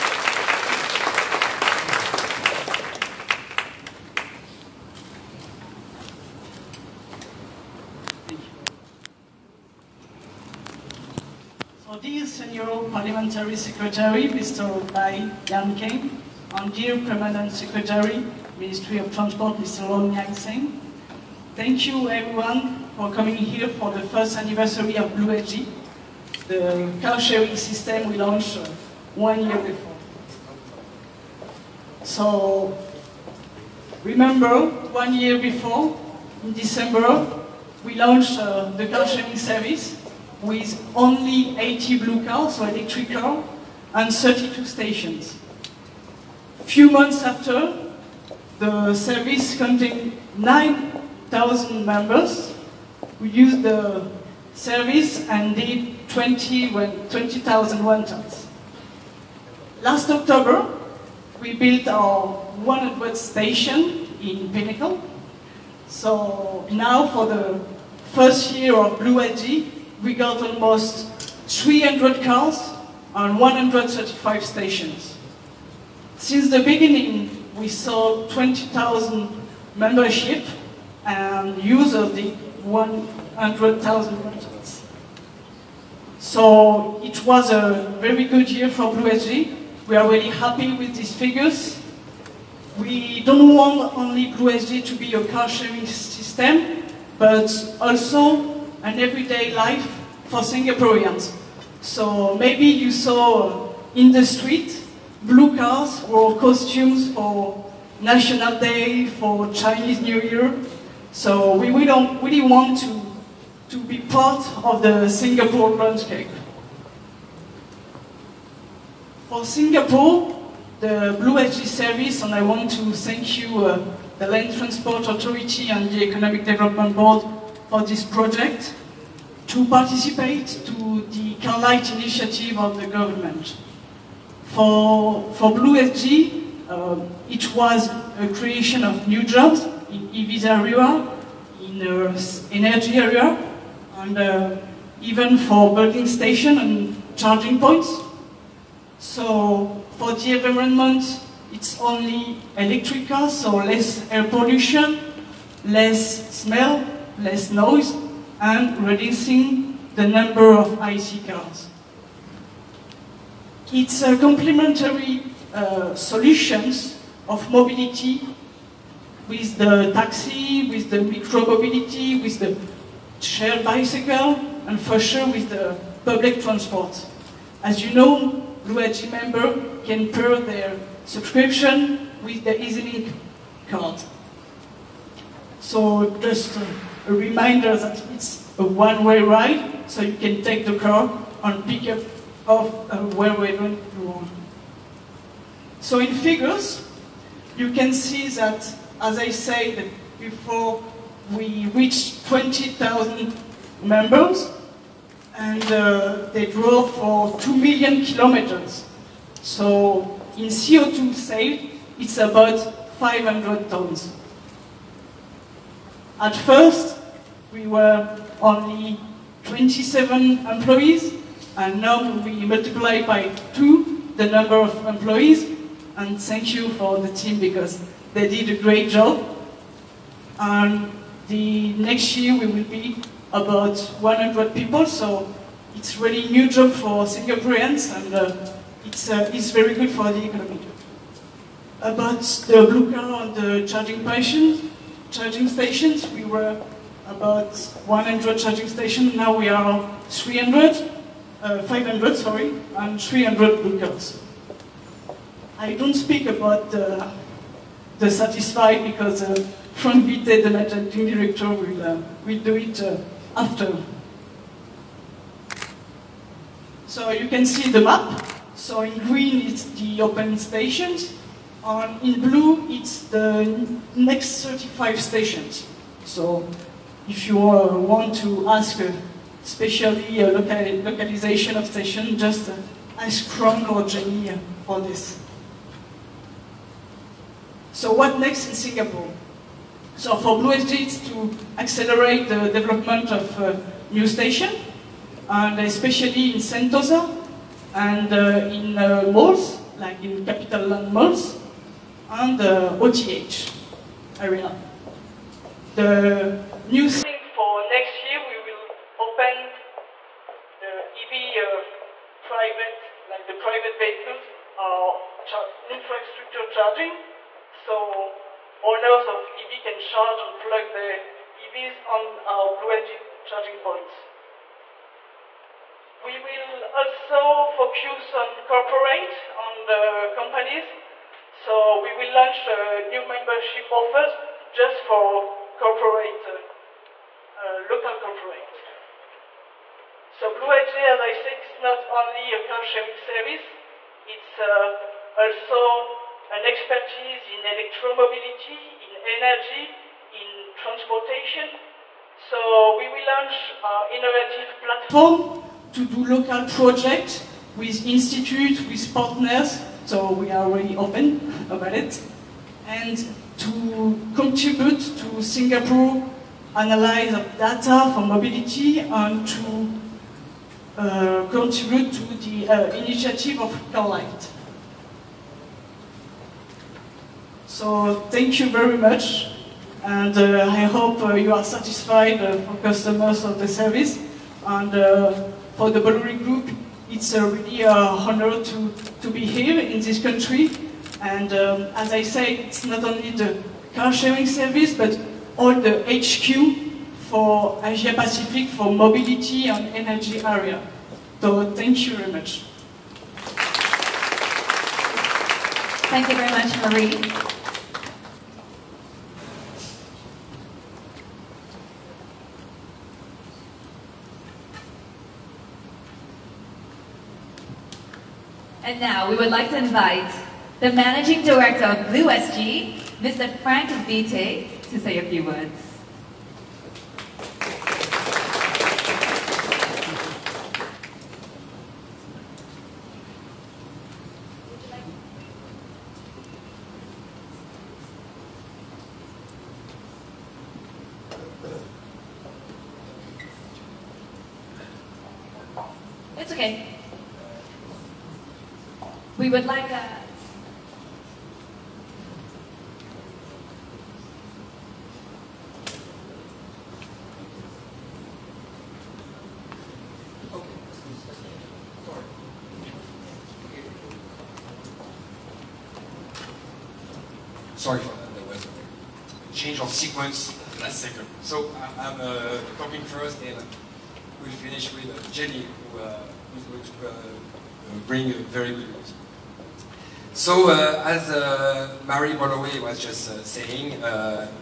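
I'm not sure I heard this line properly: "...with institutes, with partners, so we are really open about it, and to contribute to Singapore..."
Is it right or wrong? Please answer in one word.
right.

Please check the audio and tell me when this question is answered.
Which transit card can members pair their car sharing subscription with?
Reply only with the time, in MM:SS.
03:02.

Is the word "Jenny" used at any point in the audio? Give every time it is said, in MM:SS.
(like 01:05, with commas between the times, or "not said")
04:43, 07:55.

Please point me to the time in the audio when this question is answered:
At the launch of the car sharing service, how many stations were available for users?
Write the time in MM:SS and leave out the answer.
00:44.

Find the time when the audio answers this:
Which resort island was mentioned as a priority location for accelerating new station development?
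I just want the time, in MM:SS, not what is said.
04:56.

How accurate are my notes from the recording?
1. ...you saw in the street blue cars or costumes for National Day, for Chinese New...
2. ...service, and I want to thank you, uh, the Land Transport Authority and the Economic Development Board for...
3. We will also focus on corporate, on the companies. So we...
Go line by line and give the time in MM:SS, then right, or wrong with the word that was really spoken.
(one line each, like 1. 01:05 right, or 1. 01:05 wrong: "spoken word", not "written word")
1. 01:42 right
2. 02:01 right
3. 05:26 right.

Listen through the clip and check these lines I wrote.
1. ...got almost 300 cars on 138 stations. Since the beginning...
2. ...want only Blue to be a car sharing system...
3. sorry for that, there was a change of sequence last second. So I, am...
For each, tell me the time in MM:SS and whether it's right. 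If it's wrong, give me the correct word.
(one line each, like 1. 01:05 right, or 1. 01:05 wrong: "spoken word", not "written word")
1. 01:10 wrong: "135", not "138"
2. 01:33 right
3. 07:47 right.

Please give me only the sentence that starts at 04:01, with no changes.
About the blue car and the charging stations, charging stations, we were about 100 charging stations.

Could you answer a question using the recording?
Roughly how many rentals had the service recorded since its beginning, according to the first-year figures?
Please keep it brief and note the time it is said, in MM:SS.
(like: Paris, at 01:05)
100,000, at 01:22.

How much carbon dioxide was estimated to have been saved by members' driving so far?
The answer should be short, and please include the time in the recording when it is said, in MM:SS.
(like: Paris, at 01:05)
500 tons, at 03:32.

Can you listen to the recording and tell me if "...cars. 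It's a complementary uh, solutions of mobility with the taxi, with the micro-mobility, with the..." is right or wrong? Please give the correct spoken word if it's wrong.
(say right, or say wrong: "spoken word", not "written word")
right.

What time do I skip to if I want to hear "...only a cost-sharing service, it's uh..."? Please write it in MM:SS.
05:41.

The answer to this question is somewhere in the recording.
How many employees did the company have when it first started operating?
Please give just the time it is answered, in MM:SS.
03:39.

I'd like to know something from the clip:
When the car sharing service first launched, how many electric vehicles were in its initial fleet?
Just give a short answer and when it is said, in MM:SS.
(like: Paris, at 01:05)
80, at 00:41.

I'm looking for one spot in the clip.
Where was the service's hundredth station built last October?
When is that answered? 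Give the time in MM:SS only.
01:04.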